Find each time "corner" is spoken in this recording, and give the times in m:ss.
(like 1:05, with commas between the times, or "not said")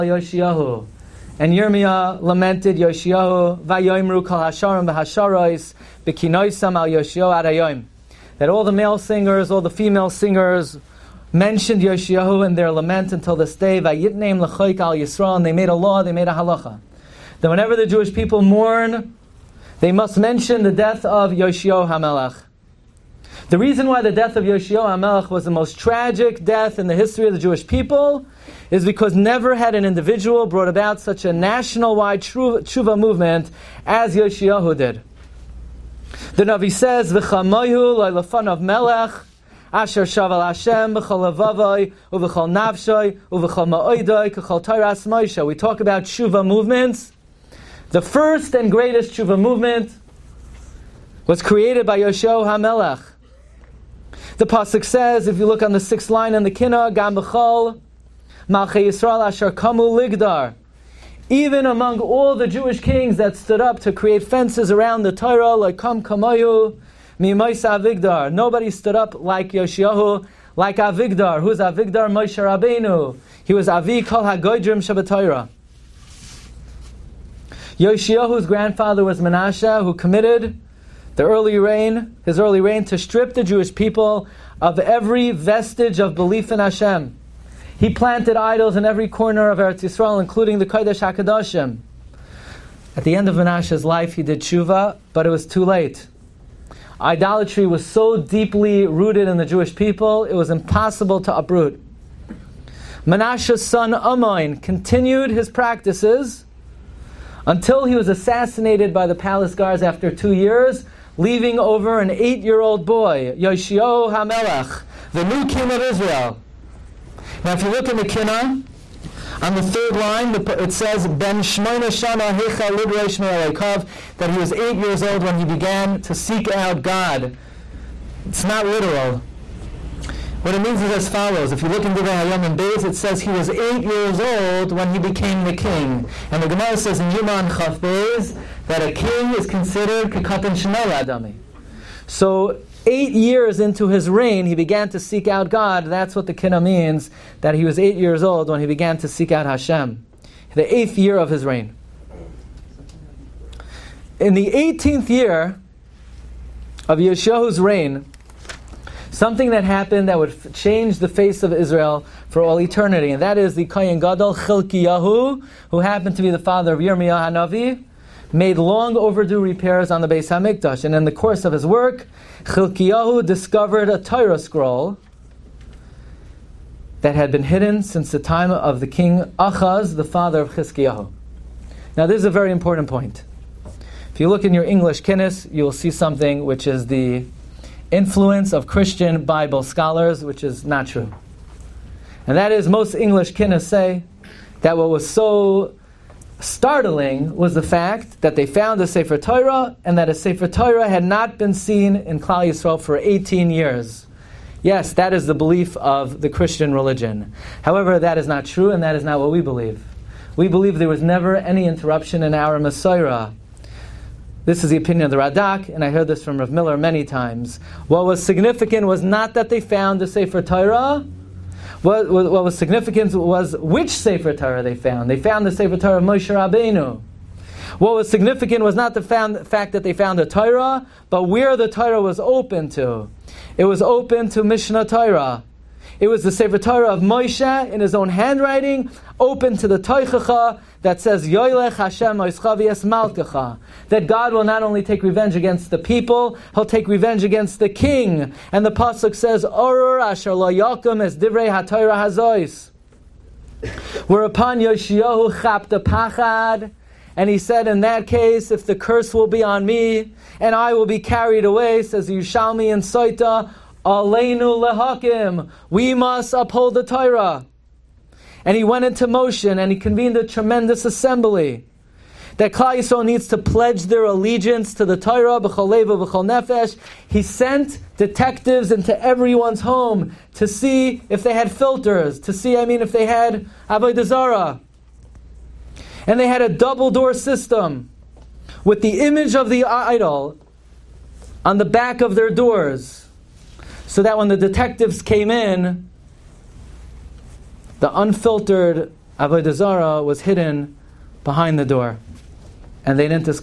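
1:29.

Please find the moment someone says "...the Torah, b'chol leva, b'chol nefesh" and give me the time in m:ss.
4:34.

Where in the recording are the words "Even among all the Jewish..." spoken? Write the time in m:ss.
1:01.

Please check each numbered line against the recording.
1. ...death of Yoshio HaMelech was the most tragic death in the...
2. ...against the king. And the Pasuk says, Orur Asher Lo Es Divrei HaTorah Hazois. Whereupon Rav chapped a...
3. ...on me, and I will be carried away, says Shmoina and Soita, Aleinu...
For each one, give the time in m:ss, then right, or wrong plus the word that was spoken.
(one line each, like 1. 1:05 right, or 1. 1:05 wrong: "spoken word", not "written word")
1. 0:24 right
2. 4:07 wrong: "Yoshiyahu", not "Rav"
3. 4:19 wrong: "Yushalmi", not "Shmoina".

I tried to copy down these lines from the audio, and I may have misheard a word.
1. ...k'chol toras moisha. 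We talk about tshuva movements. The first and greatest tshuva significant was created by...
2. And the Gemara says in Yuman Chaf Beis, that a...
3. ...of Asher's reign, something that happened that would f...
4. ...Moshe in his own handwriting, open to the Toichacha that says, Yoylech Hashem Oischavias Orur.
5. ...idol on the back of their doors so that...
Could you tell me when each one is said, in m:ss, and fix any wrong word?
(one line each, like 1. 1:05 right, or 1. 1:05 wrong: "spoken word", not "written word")
1. 0:44 wrong: "movement", not "significant"
2. 2:16 right
3. 2:36 wrong: "Yeshua", not "Asher"
4. 3:57 wrong: "Malkacha", not "Orur"
5. 4:49 right.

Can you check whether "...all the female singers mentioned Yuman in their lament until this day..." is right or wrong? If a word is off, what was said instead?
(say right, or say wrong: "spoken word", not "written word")
wrong: "Yoshiyahu", not "Yuman".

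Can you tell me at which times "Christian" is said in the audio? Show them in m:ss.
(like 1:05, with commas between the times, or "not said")
3:08, 3:26.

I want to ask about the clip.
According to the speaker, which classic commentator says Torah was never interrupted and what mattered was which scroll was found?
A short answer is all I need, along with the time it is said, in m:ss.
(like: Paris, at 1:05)
Radak, at 3:35.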